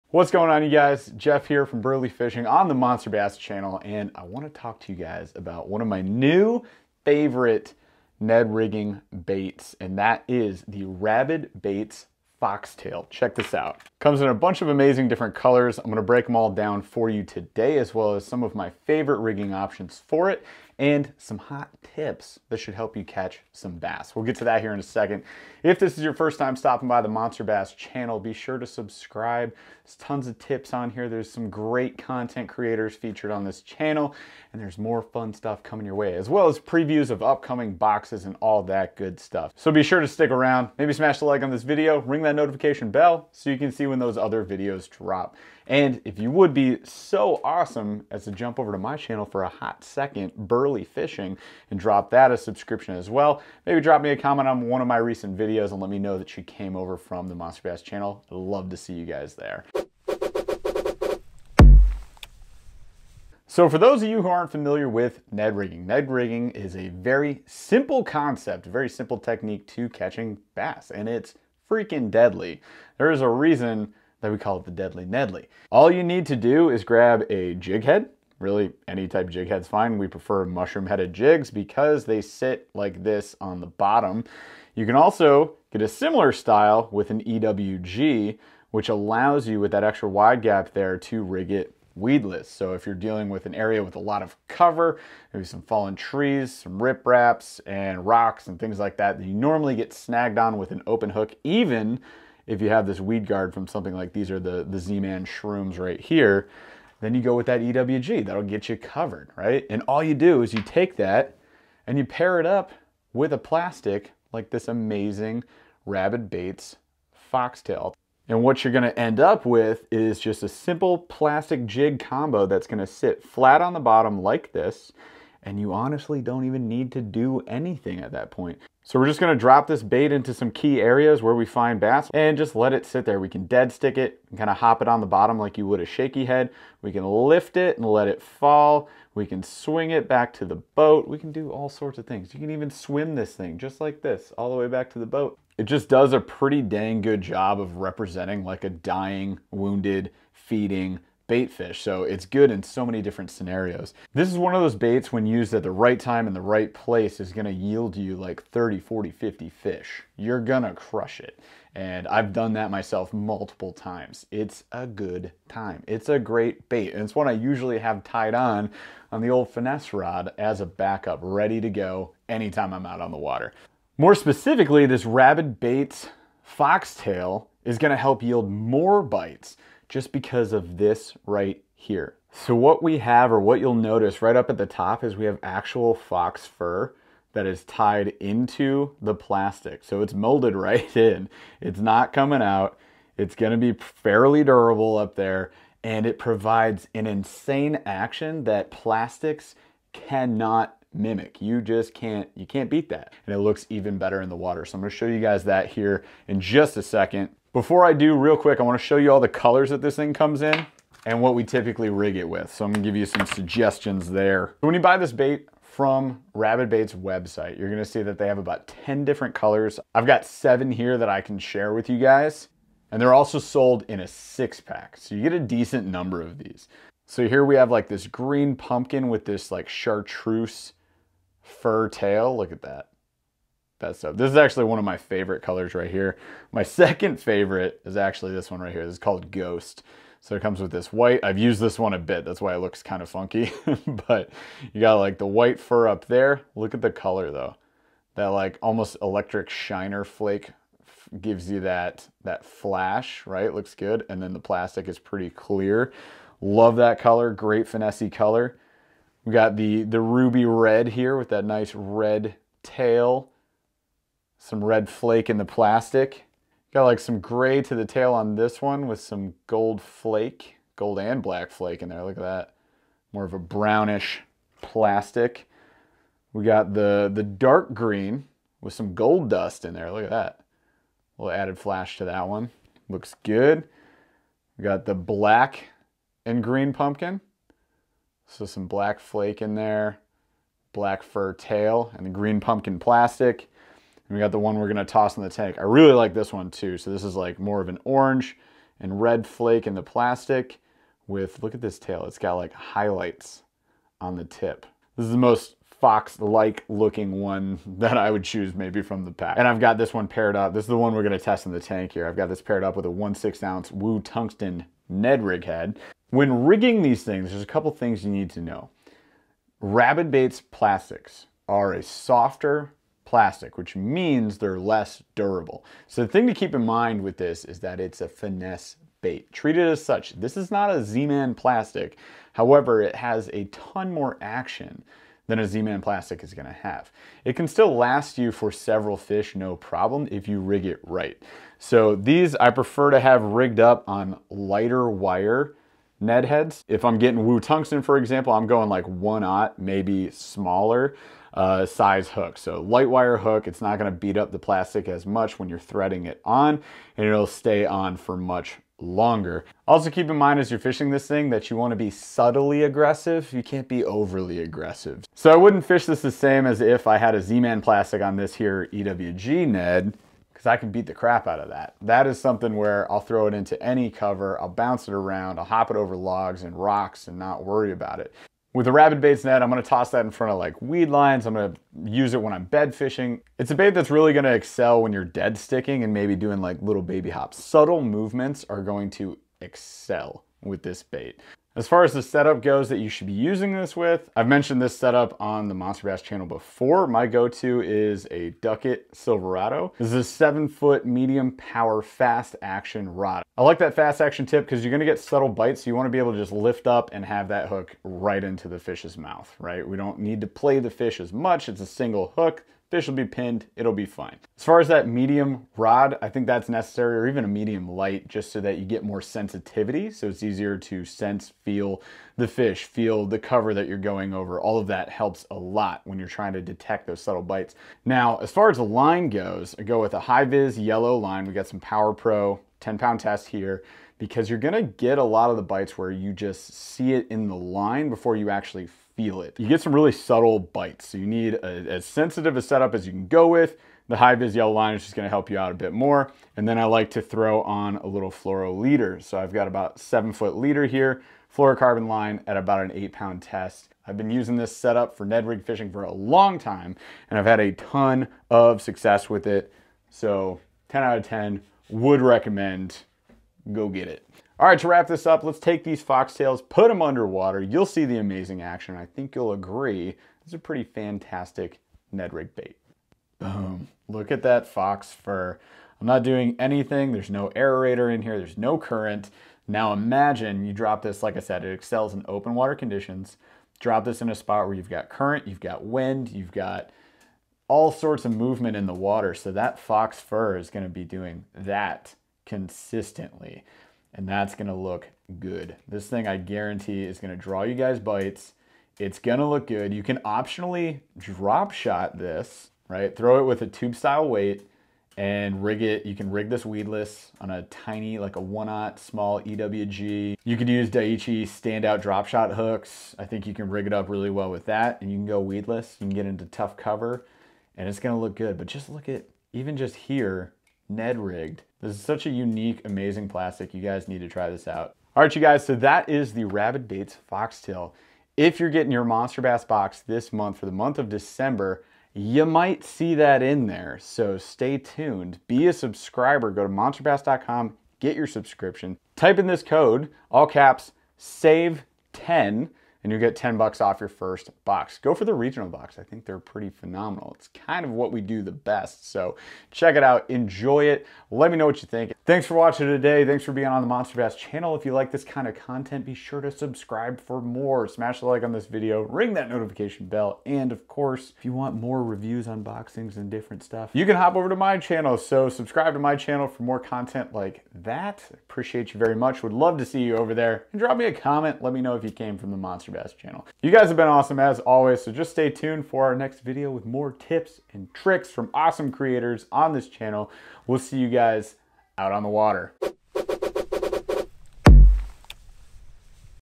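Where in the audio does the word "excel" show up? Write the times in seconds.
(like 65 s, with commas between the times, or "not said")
384 s, 389 s, 481 s.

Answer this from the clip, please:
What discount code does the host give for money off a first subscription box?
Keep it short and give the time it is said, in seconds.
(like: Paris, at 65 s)
SAVE10, at 540 s.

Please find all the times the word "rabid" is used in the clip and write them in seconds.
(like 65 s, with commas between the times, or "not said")
10 s, 115 s, 175 s, 216 s, 319 s, 378 s, 526 s.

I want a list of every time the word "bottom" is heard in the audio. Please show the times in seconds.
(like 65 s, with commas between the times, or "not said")
83 s, 123 s, 135 s.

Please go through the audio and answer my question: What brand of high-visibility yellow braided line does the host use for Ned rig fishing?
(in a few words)
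Power Pro.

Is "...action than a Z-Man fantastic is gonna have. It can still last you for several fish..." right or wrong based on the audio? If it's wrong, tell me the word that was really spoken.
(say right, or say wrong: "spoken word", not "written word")
wrong: "plastic", not "fantastic".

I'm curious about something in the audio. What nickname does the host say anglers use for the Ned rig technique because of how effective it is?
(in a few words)
Deadly Nedley.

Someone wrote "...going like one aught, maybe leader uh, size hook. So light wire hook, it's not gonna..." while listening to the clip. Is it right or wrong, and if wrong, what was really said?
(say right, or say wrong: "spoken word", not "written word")
wrong: "smaller", not "leader".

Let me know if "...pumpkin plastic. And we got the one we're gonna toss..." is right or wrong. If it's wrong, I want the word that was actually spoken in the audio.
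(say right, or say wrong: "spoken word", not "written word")
right.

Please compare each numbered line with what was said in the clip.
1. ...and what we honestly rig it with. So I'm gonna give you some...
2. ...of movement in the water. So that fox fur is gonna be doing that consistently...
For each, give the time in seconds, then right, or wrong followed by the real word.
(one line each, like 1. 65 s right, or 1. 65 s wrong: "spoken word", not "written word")
1. 211 s wrong: "typically", not "honestly"
2. 488 s right.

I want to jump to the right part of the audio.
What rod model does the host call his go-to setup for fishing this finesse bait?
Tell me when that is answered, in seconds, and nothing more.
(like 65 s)
398 s.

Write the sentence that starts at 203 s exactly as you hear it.
And it looks even better in the water.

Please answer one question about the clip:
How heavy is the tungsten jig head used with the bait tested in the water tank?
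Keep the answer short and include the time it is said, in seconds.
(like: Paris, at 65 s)
1/16 ounce, at 312 s.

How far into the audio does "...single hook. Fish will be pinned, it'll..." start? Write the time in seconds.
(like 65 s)
411 s.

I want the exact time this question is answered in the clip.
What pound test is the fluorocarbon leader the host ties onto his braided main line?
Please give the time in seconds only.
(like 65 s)
452 s.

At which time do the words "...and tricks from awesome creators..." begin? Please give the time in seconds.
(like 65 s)
577 s.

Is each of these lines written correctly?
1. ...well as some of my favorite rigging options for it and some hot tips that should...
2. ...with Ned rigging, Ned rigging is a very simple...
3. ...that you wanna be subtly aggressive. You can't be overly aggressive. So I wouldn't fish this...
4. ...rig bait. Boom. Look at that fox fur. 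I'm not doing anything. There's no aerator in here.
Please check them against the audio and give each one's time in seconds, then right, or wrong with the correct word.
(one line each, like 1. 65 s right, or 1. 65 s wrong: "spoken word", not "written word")
1. 17 s right
2. 64 s right
3. 361 s right
4. 472 s right.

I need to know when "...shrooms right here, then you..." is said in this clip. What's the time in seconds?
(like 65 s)
105 s.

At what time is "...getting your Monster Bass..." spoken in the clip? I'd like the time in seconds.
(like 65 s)
528 s.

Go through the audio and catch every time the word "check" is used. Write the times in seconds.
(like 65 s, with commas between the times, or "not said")
13 s, 549 s.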